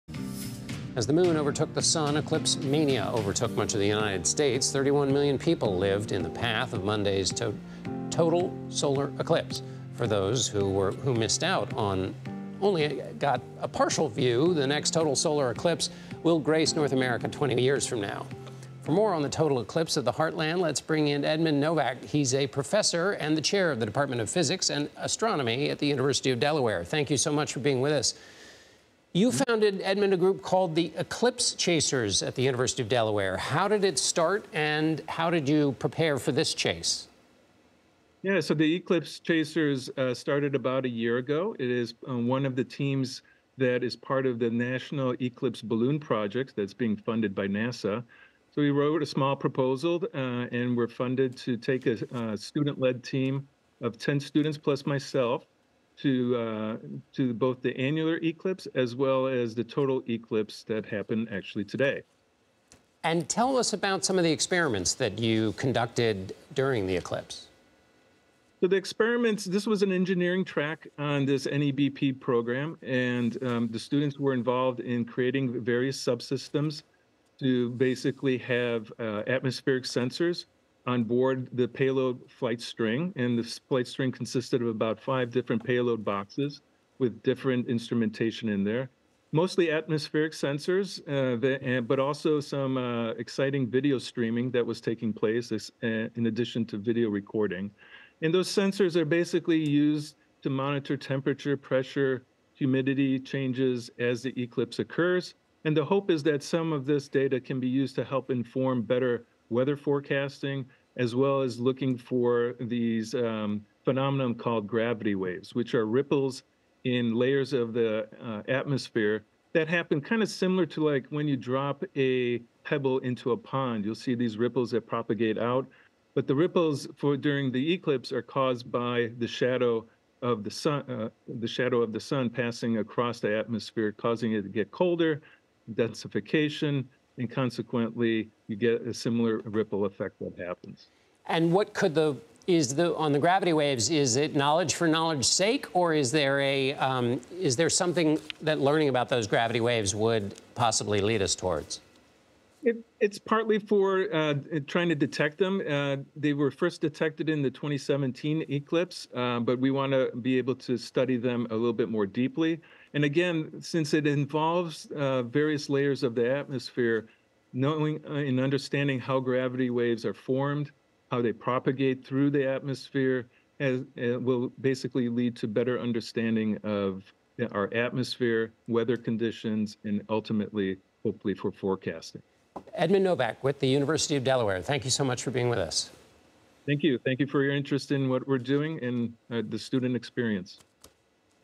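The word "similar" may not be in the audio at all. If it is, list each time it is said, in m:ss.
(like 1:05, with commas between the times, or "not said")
2:00, 2:18.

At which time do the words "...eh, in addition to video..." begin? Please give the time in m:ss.
1:35.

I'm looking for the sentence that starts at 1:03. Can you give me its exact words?
And tell us about some of the experiments that you conducted during the eclipse.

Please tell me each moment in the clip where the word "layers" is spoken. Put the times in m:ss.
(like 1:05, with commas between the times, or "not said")
1:57, 2:45.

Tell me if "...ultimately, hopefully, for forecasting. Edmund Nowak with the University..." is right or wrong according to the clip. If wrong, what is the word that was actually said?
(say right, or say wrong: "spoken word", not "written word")
right.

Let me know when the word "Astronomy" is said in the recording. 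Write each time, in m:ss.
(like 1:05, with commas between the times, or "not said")
0:24.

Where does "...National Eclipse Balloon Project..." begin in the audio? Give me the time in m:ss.
0:44.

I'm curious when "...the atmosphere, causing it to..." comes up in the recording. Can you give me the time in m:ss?
2:13.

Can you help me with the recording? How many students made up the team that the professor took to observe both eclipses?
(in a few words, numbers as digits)
10.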